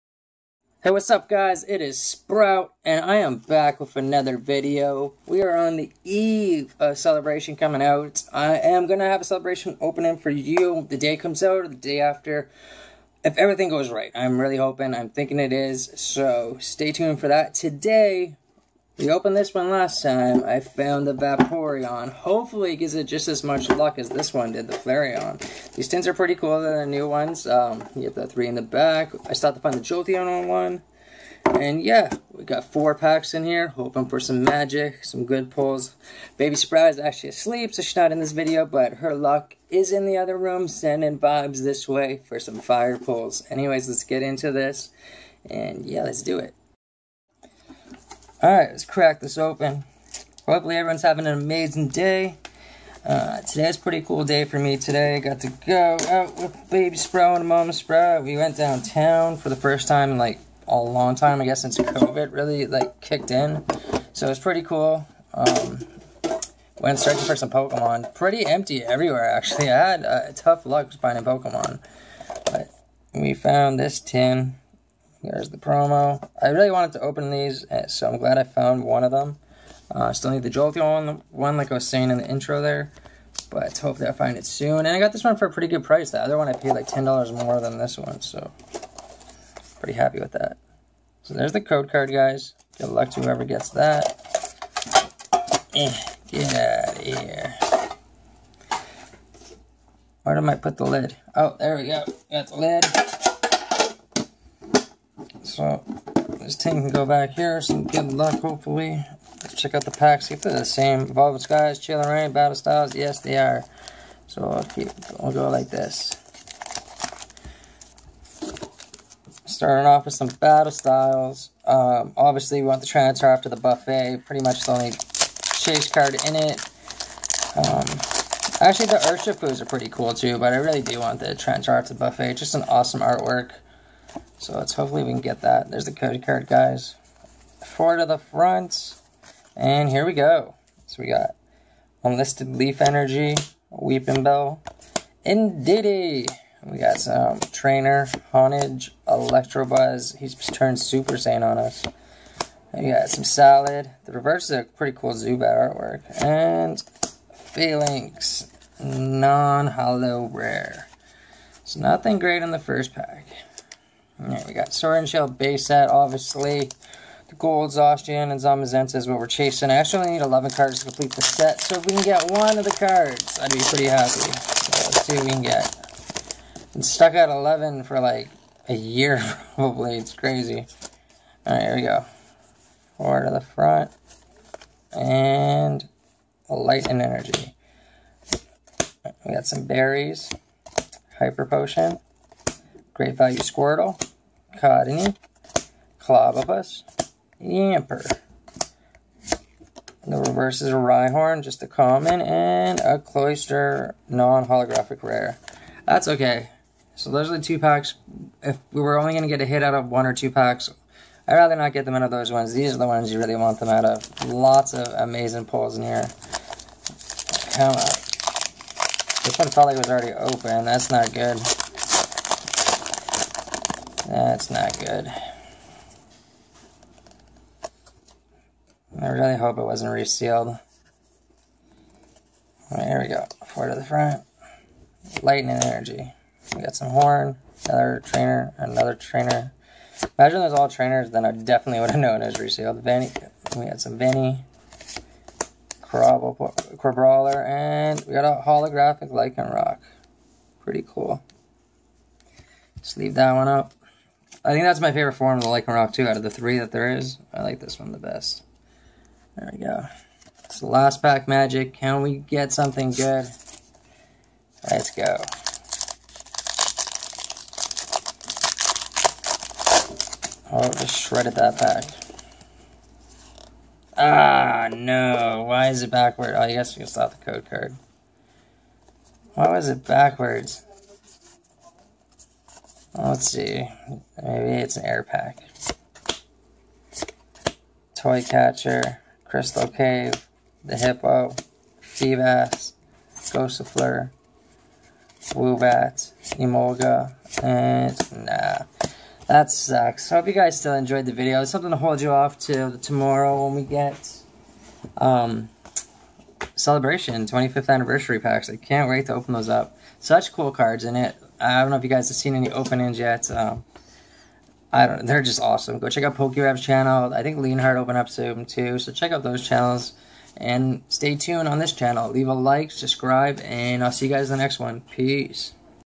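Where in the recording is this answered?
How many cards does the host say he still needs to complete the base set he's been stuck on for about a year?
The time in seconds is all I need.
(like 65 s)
170 s.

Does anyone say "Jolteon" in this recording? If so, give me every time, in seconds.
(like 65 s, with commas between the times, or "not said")
29 s, 80 s.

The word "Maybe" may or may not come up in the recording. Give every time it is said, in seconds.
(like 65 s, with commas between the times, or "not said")
284 s.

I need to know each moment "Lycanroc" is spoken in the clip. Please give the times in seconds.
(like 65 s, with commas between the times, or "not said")
249 s, 255 s.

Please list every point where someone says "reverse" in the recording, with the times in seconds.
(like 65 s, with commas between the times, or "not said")
154 s, 200 s.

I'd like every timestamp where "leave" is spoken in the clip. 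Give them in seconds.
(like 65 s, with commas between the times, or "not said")
252 s, 322 s.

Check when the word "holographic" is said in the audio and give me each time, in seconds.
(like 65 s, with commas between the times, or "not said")
204 s, 248 s.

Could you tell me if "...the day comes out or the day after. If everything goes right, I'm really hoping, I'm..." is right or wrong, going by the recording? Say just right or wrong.
right.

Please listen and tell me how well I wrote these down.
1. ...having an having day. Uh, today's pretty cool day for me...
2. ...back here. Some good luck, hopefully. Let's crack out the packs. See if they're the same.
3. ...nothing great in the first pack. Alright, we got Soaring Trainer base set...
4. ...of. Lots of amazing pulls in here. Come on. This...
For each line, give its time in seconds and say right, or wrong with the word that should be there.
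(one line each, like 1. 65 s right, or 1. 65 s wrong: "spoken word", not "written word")
1. 51 s wrong: "amazing", not "having"
2. 107 s wrong: "check", not "crack"
3. 161 s wrong: "Shell", not "Trainer"
4. 213 s right.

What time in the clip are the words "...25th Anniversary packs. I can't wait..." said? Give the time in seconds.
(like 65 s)
307 s.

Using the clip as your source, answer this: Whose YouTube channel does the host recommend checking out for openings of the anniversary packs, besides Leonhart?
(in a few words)
PokeRev.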